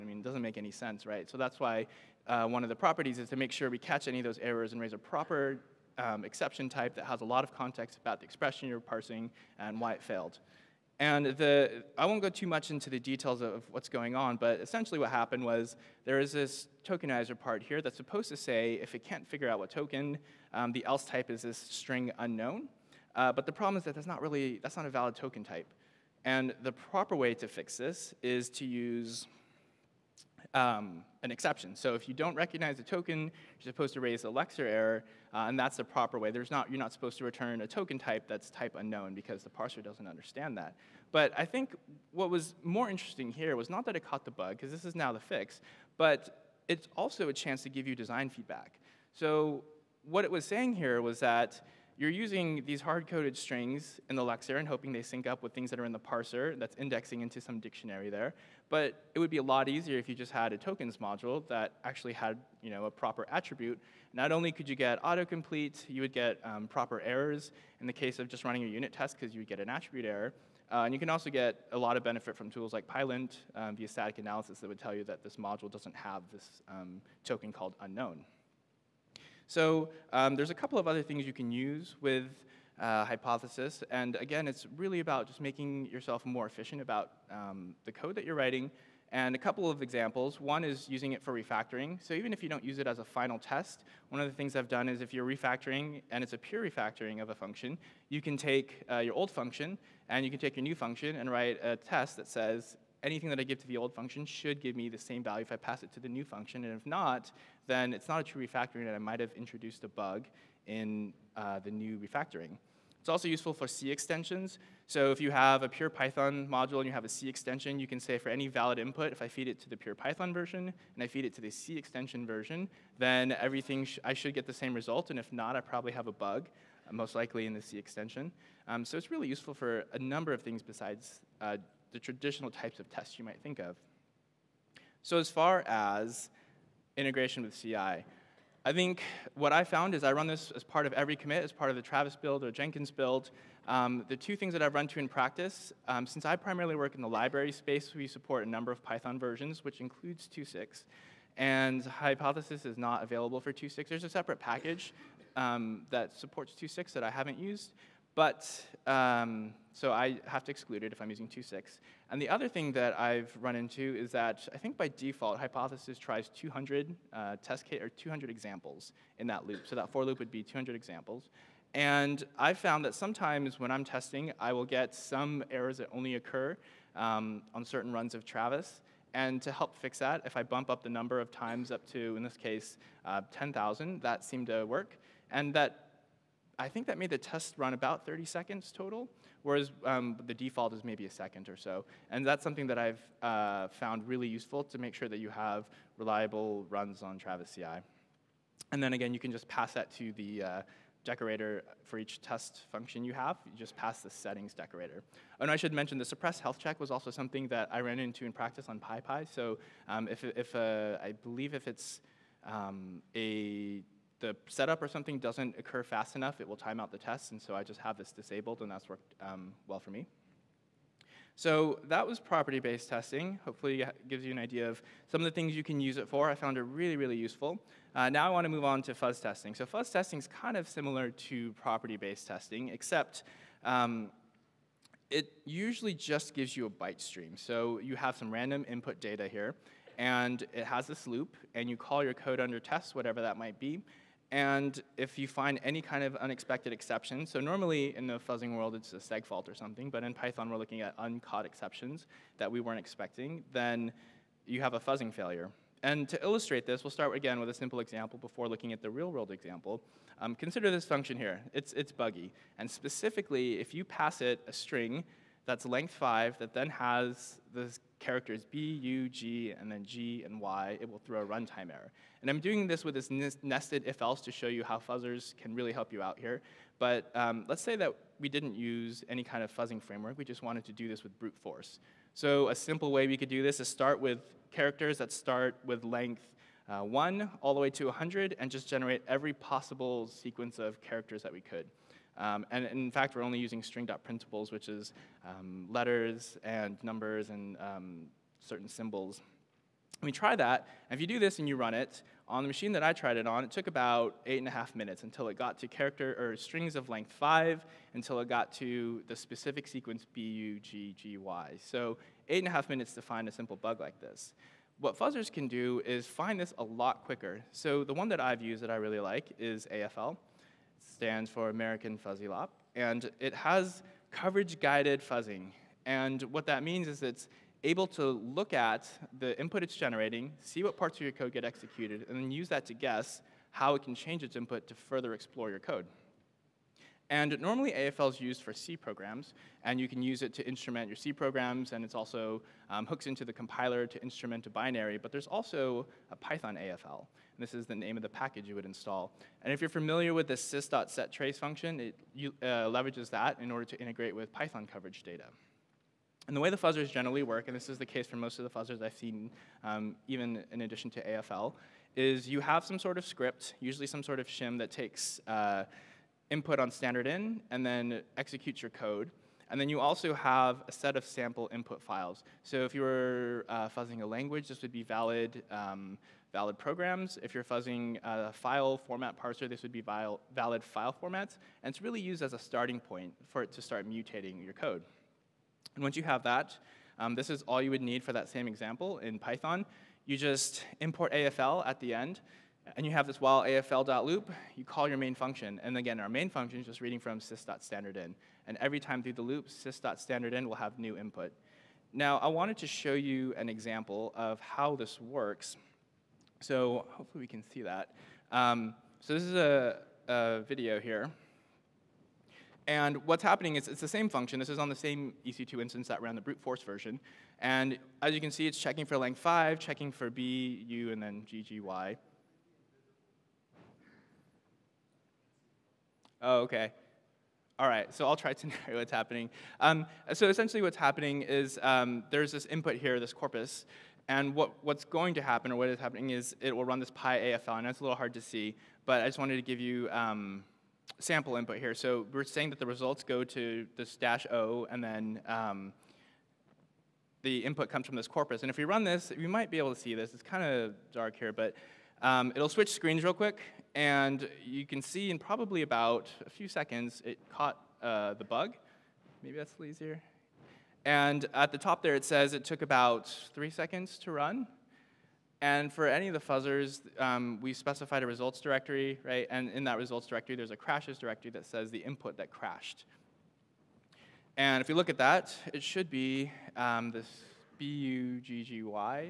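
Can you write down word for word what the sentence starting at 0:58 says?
But it would be a lot easier if you just had a tokens module that actually had you know, a proper attribute.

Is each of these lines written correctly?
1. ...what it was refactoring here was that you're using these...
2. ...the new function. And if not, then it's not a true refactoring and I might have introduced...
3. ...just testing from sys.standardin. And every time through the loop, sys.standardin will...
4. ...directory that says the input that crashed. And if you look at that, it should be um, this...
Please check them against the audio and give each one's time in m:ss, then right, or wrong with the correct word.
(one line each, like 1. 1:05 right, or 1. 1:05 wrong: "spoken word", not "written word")
1. 0:50 wrong: "saying", not "refactoring"
2. 1:45 right
3. 6:36 wrong: "reading", not "testing"
4. 7:50 right.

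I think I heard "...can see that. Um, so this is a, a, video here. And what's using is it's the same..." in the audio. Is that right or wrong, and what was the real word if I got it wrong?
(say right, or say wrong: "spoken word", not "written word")
wrong: "happening", not "using".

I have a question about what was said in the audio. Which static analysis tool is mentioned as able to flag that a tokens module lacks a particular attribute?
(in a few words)
Pylint.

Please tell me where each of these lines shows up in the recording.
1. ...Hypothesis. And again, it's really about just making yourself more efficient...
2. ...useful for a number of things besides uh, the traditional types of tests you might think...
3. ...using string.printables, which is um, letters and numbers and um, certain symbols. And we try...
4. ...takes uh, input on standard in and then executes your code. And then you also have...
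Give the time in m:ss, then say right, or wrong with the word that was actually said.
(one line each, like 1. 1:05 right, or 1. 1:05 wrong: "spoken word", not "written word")
1. 1:23 right
2. 2:09 right
3. 4:53 right
4. 6:04 right.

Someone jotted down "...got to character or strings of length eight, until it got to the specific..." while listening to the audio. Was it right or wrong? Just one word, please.
wrong.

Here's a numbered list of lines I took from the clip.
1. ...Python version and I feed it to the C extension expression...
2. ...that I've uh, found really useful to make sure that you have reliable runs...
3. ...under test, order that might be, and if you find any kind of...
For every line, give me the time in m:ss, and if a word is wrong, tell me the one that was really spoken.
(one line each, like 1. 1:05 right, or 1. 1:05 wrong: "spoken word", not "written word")
1. 1:59 wrong: "version", not "expression"
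2. 3:12 right
3. 4:02 wrong: "whatever", not "order".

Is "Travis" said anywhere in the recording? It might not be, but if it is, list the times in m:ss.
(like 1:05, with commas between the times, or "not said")
2:21, 2:58, 3:17.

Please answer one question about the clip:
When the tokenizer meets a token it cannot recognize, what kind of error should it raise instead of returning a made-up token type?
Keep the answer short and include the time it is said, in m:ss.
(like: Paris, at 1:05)
Lexer error, at 0:34.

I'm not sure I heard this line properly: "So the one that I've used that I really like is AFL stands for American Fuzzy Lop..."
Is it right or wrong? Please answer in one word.
right.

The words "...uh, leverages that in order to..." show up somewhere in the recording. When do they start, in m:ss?
5:52.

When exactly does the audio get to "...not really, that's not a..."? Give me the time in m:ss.
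0:24.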